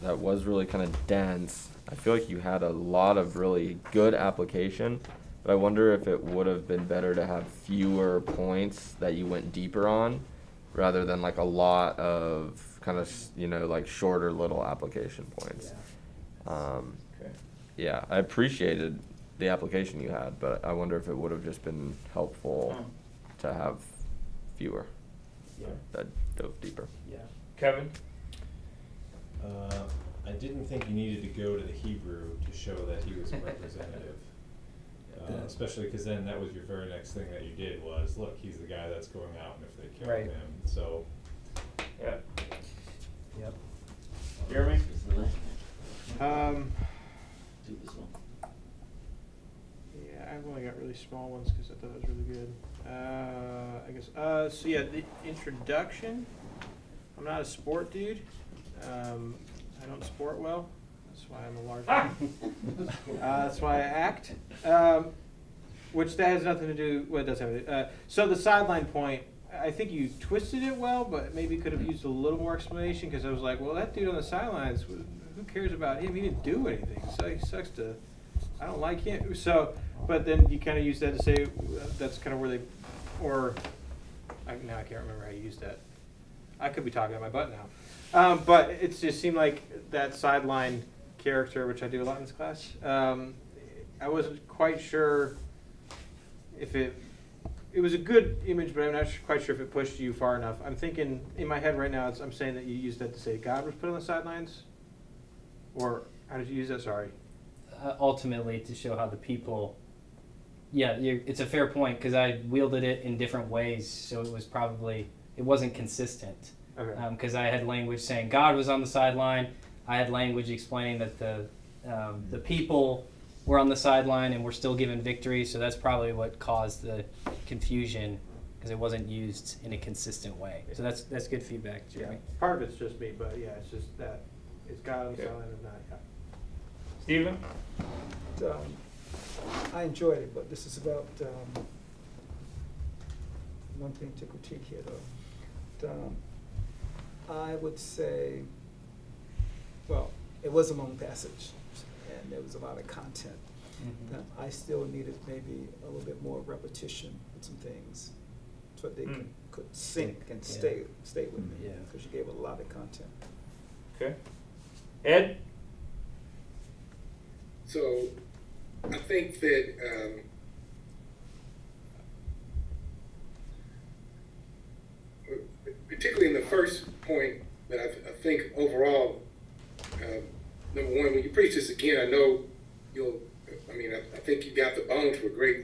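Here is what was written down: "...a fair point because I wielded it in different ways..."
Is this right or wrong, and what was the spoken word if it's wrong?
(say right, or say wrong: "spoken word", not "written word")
right.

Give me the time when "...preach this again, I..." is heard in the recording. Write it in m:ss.
3:01.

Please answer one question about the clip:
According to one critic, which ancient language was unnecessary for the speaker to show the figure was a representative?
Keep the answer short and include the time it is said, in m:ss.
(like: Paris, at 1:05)
Hebrew, at 0:31.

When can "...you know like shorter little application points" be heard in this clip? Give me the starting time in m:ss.
0:13.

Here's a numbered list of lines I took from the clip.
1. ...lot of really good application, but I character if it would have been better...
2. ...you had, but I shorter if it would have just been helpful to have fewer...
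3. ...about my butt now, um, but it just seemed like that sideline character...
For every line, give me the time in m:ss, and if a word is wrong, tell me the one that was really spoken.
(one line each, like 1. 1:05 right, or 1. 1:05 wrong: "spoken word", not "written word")
1. 0:02 wrong: "wonder", not "character"
2. 0:20 wrong: "wonder", not "shorter"
3. 1:27 right.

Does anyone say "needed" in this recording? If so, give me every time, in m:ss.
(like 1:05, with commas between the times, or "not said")
0:30, 2:34.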